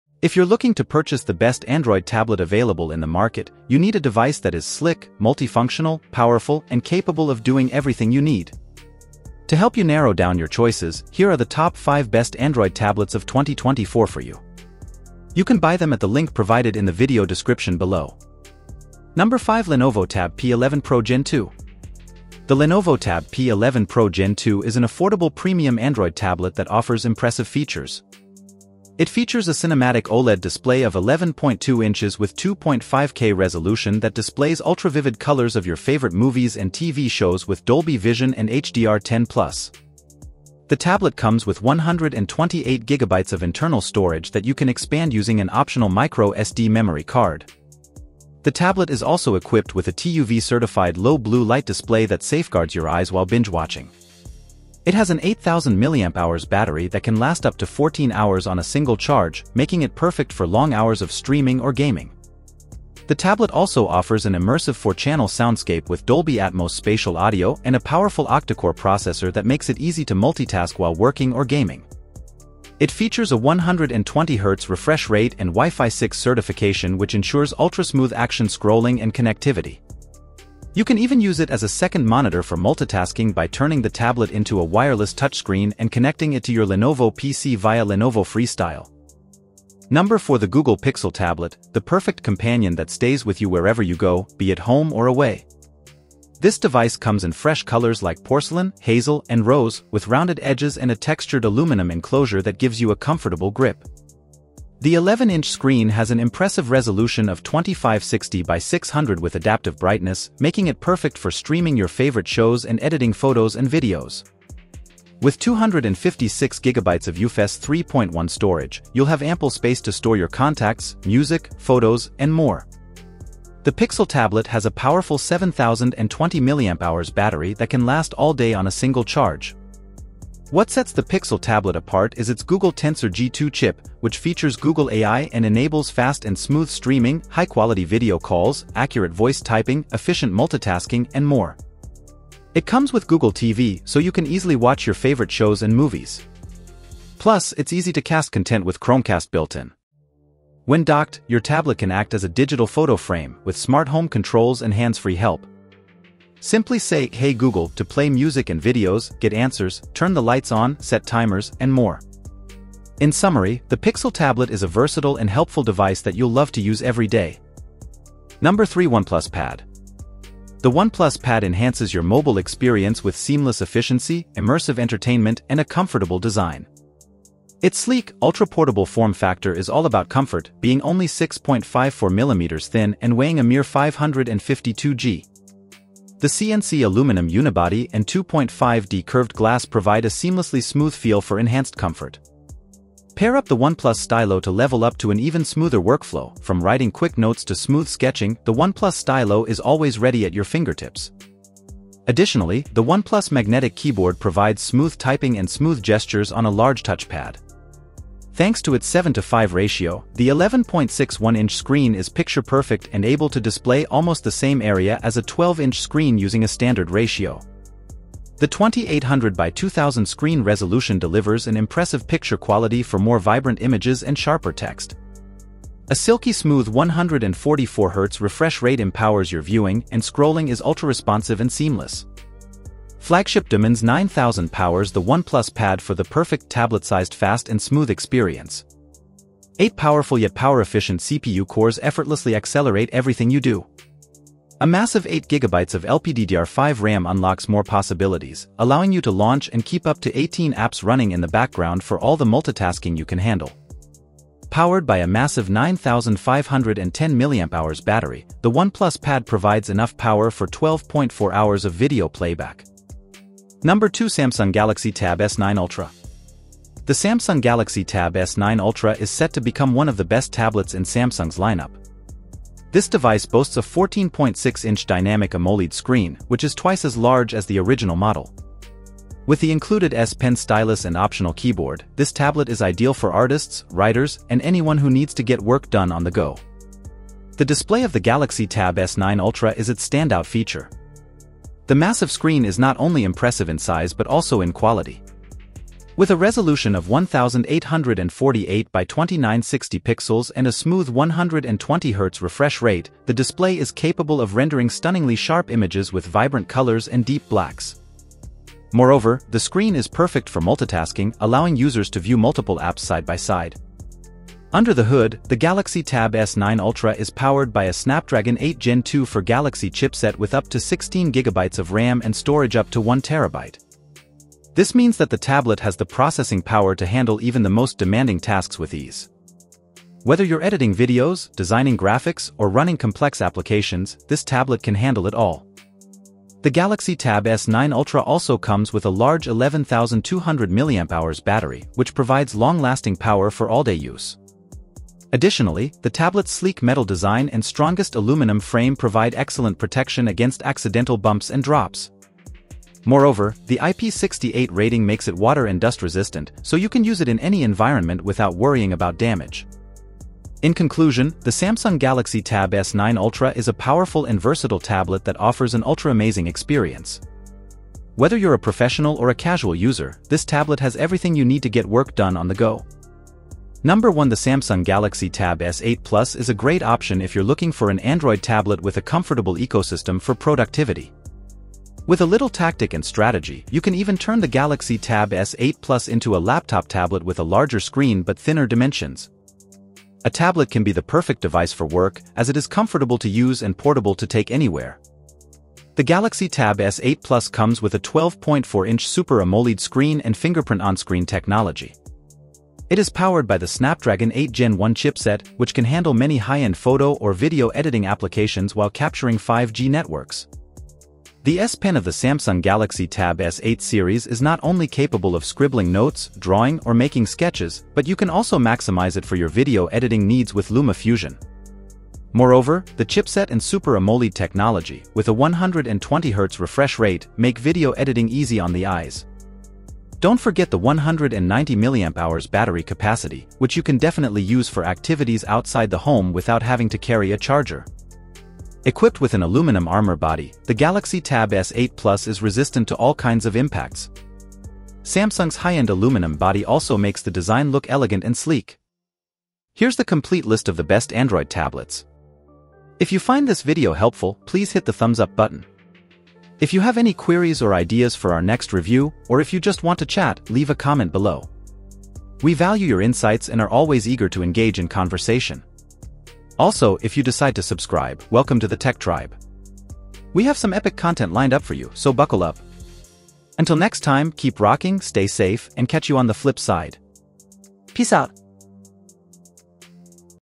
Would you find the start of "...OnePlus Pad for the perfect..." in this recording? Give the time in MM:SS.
03:55.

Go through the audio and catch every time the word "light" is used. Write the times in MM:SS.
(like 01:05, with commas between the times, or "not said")
00:51, 02:40.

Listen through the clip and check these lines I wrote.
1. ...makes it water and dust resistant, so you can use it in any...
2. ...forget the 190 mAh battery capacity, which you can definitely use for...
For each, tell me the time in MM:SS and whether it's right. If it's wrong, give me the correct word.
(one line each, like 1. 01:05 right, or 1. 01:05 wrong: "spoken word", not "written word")
1. 05:54 right
2. 07:10 right.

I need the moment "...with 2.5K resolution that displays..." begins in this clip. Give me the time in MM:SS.
00:32.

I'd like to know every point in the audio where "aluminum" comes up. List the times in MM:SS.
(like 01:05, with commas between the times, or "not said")
01:41, 03:06, 05:47, 07:19, 07:25.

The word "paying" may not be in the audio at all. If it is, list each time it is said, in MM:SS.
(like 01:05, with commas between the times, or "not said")
not said.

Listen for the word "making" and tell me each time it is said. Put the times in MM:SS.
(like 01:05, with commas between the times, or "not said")
00:59, 01:50, 06:56.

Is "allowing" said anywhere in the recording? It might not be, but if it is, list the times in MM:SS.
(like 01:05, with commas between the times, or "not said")
04:08, 05:11.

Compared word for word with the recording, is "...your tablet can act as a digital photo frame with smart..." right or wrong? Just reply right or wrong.
right.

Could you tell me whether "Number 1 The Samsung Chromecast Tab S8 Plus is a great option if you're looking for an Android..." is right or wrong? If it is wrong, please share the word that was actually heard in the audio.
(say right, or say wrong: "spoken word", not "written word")
wrong: "Galaxy", not "Chromecast".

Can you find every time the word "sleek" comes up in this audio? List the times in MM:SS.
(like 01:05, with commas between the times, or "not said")
02:57, 05:46, 07:28.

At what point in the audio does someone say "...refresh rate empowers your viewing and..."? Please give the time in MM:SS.
03:48.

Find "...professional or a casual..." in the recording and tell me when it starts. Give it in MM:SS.
06:08.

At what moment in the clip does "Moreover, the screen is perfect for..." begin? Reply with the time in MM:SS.
05:08.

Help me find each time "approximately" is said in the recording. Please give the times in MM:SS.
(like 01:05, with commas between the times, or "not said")
not said.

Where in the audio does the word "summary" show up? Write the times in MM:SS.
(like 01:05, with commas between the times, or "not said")
02:43.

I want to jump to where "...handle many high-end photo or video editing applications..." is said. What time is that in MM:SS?
06:45.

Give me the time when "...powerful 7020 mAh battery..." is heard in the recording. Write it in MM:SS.
02:04.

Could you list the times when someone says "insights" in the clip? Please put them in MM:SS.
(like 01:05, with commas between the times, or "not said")
07:42.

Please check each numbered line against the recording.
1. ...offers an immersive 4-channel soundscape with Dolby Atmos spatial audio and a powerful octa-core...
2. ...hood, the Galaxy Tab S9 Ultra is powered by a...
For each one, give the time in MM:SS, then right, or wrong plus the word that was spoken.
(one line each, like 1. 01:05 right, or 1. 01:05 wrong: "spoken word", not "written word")
1. 01:03 right
2. 05:14 right.